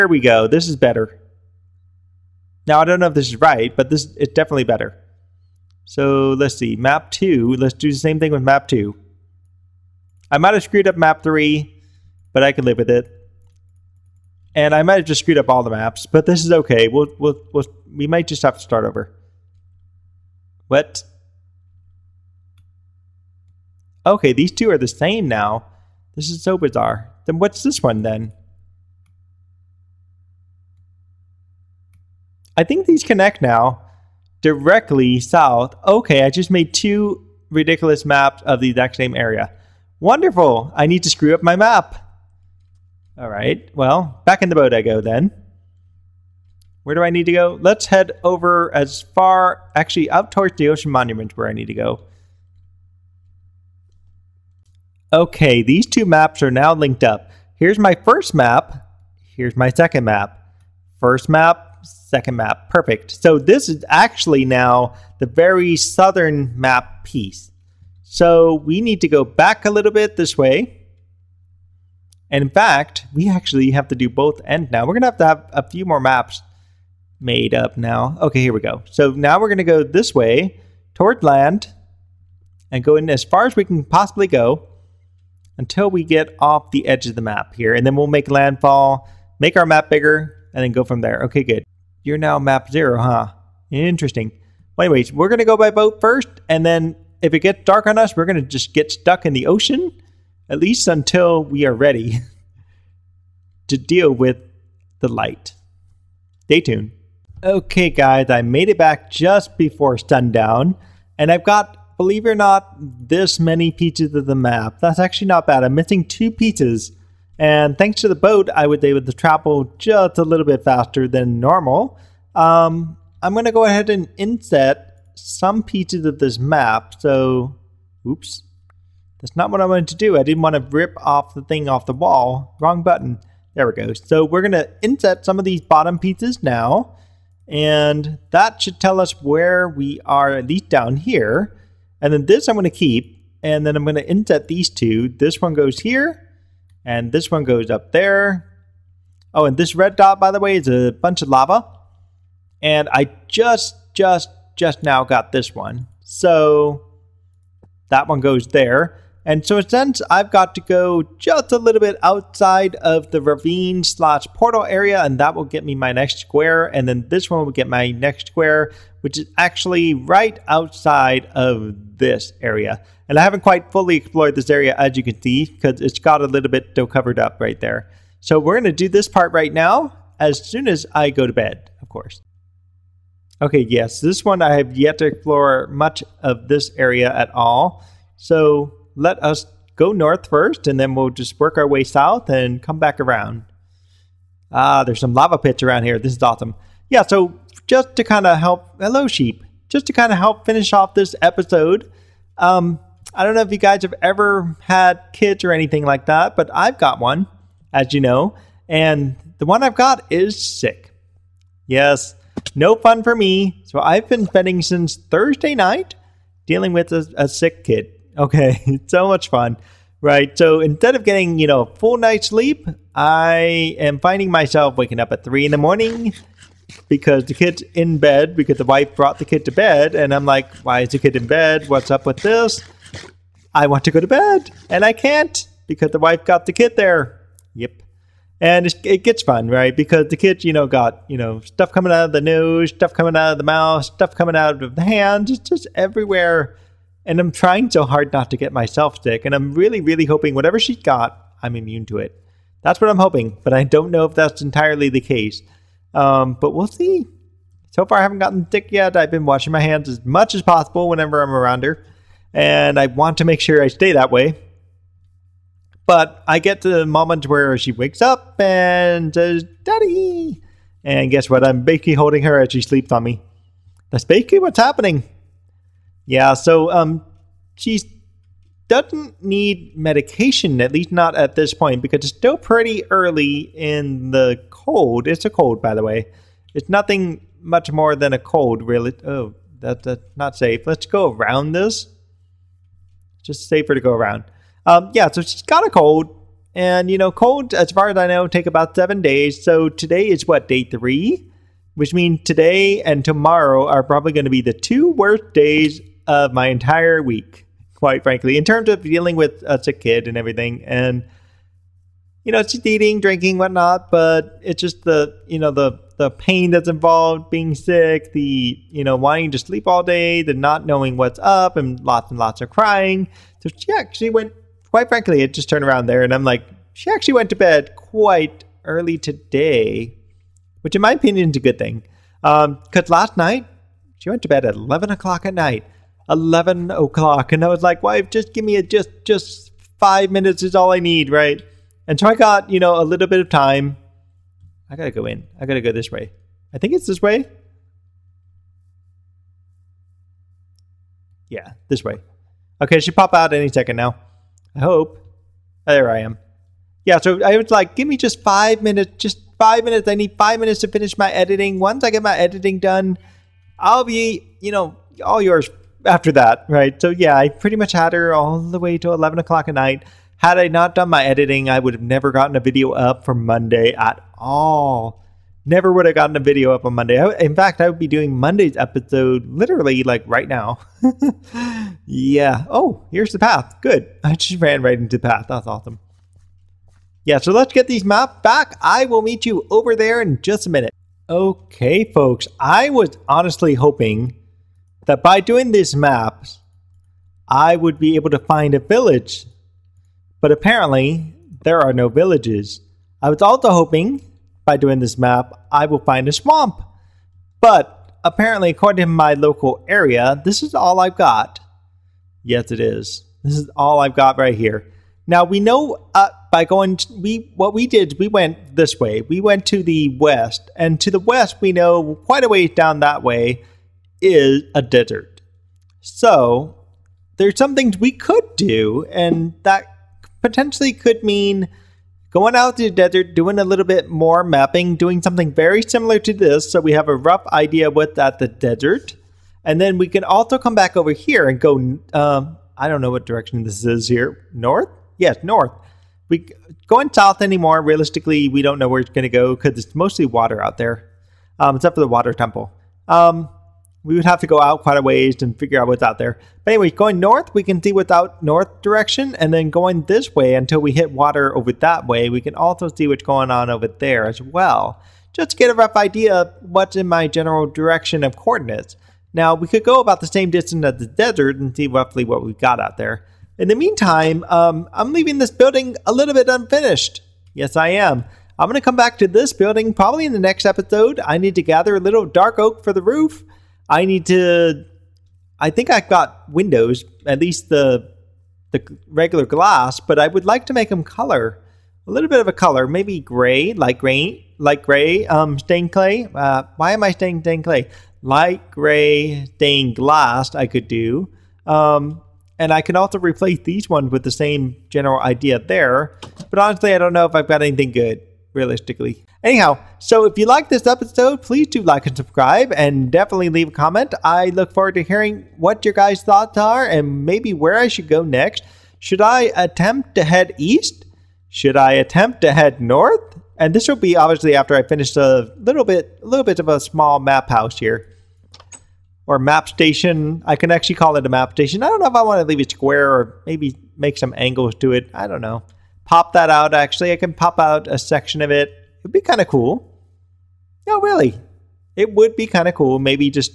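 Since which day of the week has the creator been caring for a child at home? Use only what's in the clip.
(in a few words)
Thursday.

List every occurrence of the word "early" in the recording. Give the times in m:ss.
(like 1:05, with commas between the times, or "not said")
4:42, 5:28.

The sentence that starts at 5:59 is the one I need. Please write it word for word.
I need five minutes to finish my editing.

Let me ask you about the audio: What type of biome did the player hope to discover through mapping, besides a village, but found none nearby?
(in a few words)
Swamp.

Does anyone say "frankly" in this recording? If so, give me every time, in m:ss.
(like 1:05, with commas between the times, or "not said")
5:08, 5:24.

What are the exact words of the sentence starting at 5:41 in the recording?
And so I got, you know, a little bit of time.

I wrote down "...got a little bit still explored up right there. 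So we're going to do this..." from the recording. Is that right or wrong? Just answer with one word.
wrong.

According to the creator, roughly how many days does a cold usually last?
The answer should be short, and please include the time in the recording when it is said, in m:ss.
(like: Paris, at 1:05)
7, at 4:58.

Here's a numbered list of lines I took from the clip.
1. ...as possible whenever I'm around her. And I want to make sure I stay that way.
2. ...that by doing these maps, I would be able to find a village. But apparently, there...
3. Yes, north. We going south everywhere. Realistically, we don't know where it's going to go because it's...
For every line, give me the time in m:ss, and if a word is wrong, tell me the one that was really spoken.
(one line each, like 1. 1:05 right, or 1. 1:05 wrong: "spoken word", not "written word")
1. 4:20 right
2. 6:34 right
3. 7:24 wrong: "anymore", not "everywhere".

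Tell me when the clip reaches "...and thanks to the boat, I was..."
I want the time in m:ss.
1:57.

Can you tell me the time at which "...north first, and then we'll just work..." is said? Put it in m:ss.
3:09.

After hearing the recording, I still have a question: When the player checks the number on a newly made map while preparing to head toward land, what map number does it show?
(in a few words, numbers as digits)
0.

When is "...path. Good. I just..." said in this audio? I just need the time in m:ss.
6:23.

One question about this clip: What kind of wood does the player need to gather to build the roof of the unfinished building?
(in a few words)
Dark oak.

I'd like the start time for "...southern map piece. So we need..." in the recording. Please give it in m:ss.
1:05.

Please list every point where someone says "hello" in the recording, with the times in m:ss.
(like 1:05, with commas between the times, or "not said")
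3:18.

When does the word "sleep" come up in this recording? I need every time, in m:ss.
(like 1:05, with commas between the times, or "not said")
3:42, 4:32, 5:19.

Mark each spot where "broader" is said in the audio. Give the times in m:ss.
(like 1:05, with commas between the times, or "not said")
not said.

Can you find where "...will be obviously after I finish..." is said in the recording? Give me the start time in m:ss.
8:43.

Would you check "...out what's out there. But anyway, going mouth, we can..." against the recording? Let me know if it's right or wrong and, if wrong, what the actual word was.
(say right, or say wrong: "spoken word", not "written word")
wrong: "north", not "mouth".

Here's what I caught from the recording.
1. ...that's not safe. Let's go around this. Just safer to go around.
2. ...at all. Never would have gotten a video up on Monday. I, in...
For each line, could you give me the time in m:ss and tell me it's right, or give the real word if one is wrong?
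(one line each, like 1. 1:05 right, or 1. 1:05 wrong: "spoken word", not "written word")
1. 4:49 right
2. 6:13 right.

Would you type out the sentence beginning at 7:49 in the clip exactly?
Now, we could go about the same distance as the desert and see roughly what we've got out there.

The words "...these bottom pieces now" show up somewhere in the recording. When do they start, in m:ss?
2:15.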